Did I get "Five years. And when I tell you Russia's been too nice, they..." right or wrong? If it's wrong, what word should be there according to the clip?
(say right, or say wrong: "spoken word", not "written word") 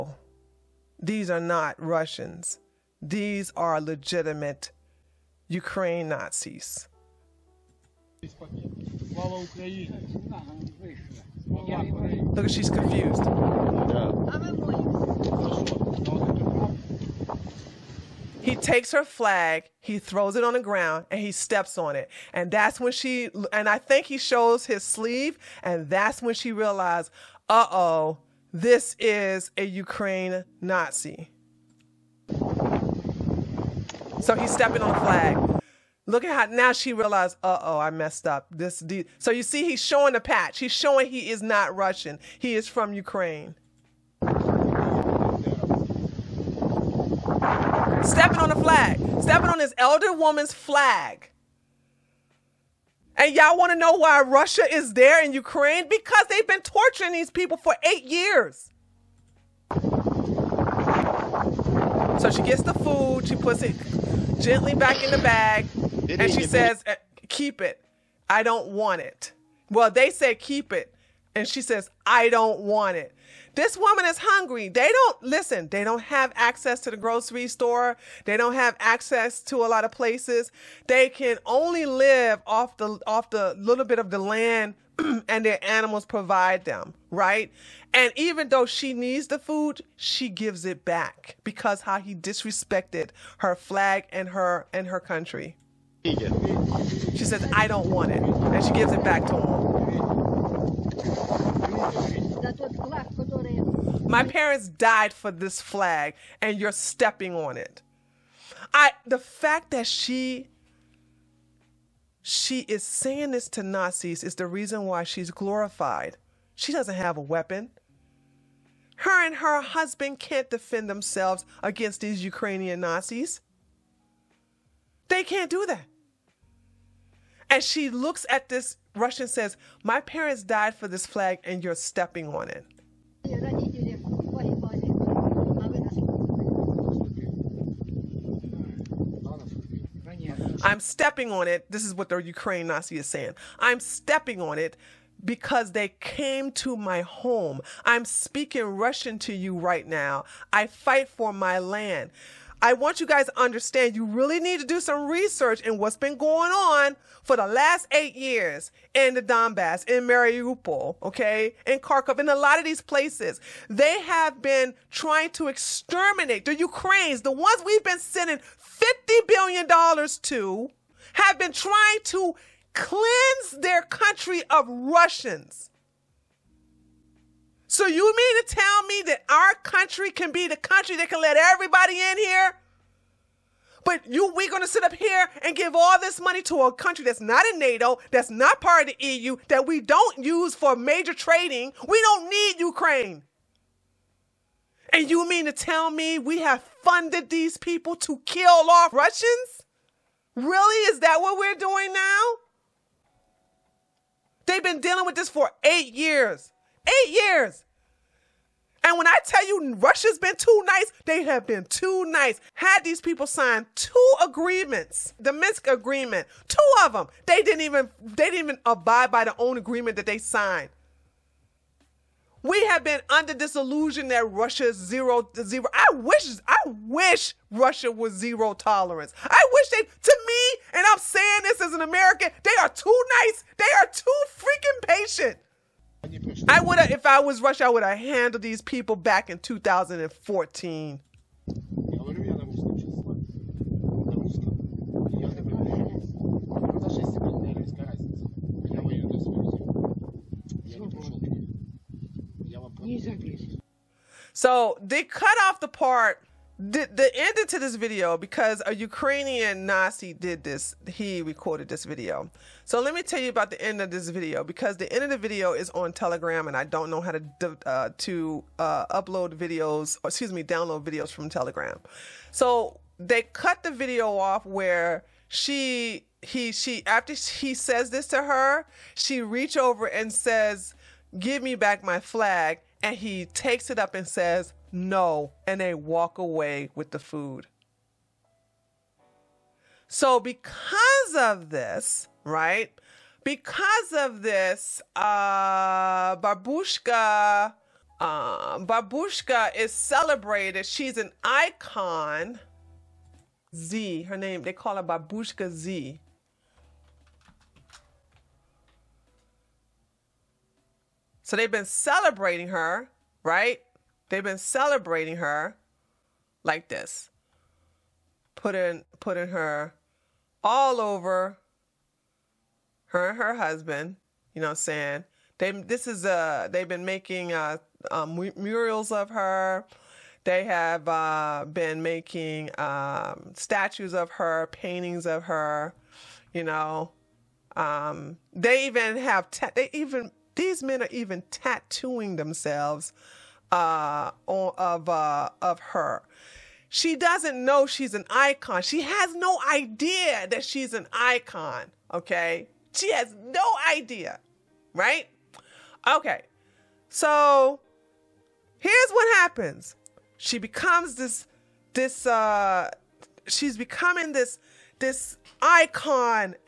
wrong: "Eight", not "Five".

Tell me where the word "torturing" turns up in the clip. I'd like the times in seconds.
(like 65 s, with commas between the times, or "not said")
56 s.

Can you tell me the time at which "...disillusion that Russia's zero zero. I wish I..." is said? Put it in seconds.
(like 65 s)
223 s.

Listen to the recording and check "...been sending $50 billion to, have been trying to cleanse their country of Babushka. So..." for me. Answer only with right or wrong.
wrong.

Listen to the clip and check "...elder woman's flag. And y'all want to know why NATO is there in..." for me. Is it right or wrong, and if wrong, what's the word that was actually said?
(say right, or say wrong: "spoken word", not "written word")
wrong: "Russia", not "NATO".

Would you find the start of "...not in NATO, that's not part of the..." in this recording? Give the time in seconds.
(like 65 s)
187 s.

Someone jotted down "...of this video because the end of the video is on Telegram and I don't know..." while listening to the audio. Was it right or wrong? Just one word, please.
right.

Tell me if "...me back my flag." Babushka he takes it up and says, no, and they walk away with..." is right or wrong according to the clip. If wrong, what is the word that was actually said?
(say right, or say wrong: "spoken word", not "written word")
wrong: "And", not "Babushka".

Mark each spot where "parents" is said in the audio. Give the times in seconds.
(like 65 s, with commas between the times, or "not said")
104 s, 129 s.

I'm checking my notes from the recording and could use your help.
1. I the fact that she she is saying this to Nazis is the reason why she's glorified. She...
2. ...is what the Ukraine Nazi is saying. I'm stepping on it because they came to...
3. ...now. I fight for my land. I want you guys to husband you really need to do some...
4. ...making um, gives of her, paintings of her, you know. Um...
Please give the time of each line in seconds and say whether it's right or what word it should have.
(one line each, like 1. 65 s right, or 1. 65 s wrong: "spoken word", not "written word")
1. 108 s right
2. 141 s right
3. 149 s wrong: "understand", not "husband"
4. 331 s wrong: "statues", not "gives".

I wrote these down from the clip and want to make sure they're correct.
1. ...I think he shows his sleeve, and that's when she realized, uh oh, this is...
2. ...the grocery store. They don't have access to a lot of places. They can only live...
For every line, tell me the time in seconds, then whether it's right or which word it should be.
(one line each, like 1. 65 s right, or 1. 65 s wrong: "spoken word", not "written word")
1. 23 s right
2. 76 s right.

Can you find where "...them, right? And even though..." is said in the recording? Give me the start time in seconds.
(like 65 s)
86 s.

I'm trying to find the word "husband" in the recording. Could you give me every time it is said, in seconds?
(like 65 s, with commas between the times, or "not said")
119 s, 323 s.